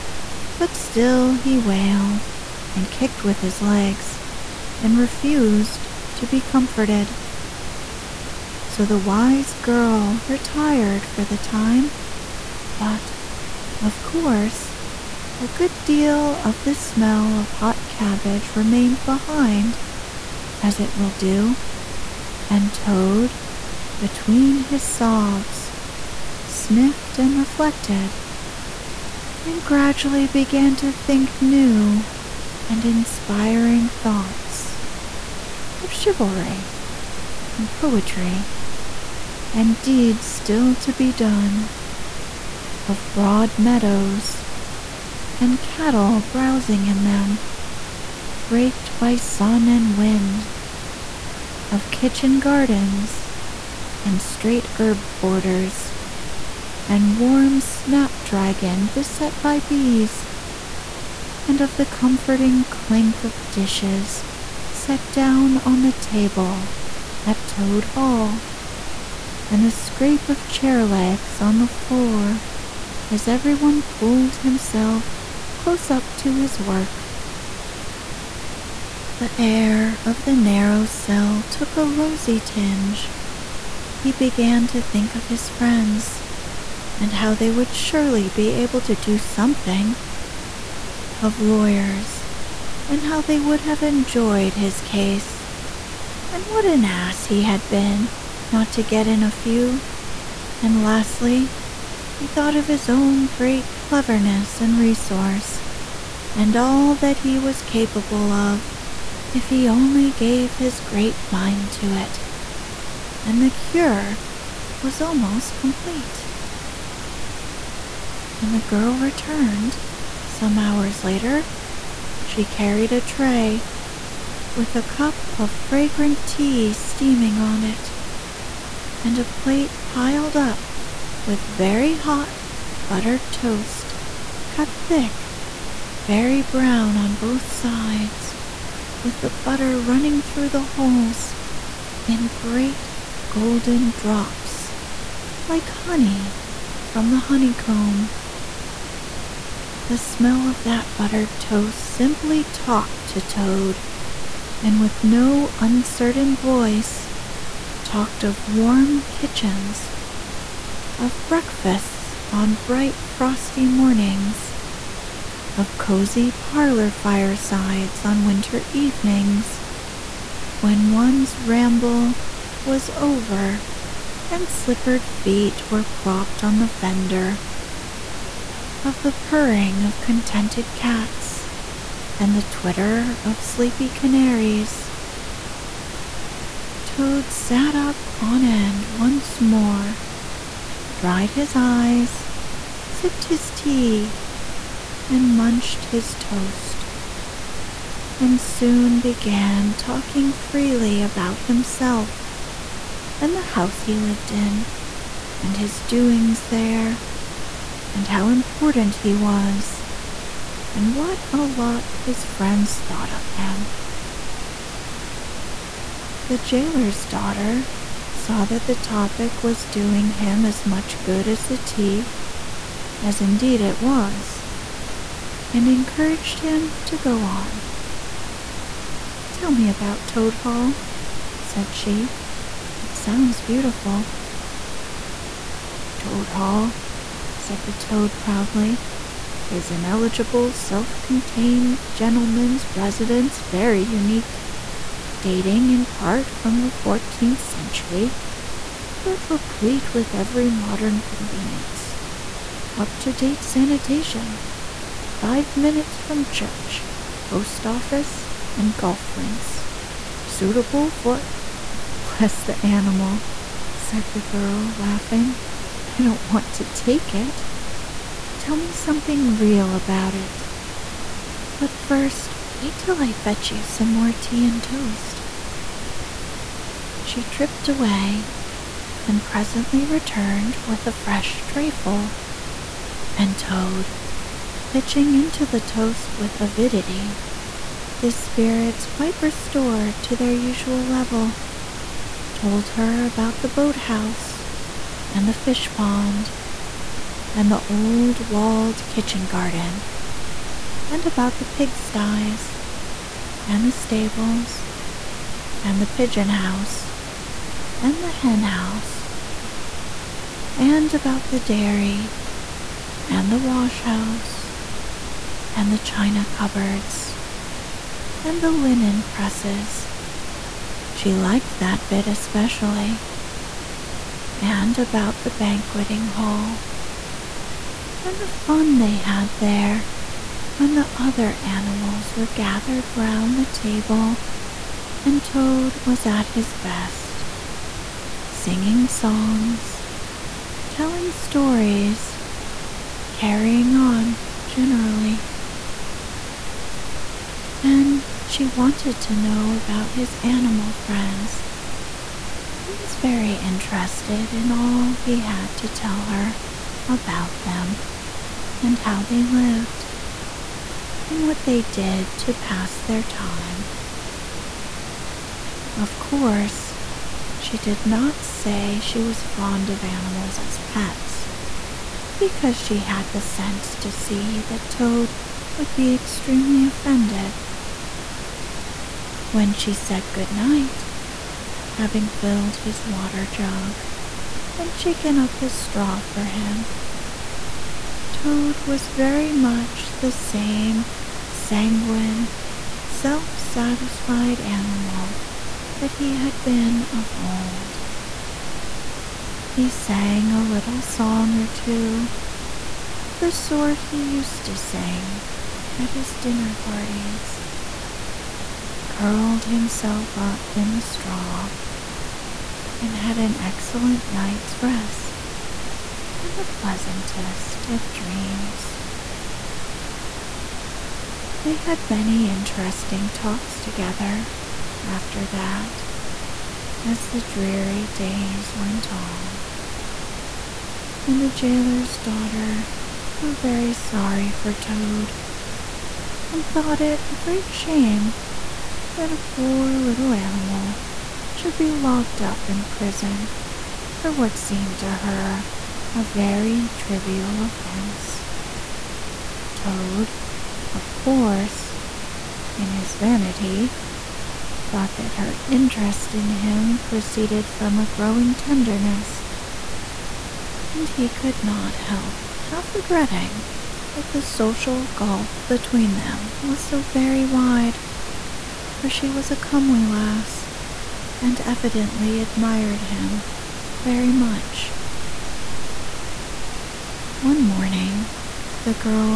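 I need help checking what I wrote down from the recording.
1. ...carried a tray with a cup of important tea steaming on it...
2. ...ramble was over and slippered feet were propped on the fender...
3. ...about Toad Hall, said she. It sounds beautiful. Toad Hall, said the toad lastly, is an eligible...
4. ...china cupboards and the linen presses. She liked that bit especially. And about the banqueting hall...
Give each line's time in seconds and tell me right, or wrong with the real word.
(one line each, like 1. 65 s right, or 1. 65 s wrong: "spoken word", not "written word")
1. 122 s wrong: "fragrant", not "important"
2. 171 s right
3. 229 s wrong: "proudly", not "lastly"
4. 315 s right.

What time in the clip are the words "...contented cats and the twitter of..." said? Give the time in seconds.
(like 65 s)
179 s.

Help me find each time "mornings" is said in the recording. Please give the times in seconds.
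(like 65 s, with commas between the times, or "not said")
163 s, 477 s.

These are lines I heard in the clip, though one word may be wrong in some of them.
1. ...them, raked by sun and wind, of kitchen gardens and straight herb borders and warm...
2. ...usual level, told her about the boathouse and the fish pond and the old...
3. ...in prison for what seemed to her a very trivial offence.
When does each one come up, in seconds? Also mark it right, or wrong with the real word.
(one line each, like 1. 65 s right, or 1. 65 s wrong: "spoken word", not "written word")
1. 47 s right
2. 290 s right
3. 442 s right.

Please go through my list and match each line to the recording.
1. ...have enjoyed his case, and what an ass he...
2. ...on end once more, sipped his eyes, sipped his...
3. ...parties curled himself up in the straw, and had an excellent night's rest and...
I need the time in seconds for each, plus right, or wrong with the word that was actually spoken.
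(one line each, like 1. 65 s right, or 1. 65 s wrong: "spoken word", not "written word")
1. 93 s right
2. 188 s wrong: "dried", not "sipped"
3. 406 s right.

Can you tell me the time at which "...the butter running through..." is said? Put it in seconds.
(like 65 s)
139 s.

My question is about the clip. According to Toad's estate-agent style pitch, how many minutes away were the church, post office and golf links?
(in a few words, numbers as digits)
5.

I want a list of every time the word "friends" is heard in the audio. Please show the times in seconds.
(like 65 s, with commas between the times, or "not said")
85 s, 212 s, 350 s.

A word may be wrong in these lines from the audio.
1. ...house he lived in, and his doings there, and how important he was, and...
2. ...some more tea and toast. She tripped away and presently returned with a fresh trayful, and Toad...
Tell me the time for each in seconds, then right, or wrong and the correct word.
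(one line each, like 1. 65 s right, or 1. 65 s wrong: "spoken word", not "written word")
1. 203 s right
2. 273 s right.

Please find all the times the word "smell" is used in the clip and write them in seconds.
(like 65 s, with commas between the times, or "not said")
16 s, 149 s.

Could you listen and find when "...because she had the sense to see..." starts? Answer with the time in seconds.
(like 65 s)
372 s.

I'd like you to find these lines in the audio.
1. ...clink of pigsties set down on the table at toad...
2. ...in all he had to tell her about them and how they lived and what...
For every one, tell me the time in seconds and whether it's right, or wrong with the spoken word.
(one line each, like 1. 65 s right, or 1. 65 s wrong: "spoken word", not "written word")
1. 62 s wrong: "dishes", not "pigsties"
2. 354 s right.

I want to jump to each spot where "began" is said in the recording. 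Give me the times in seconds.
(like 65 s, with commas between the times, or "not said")
30 s, 84 s, 199 s.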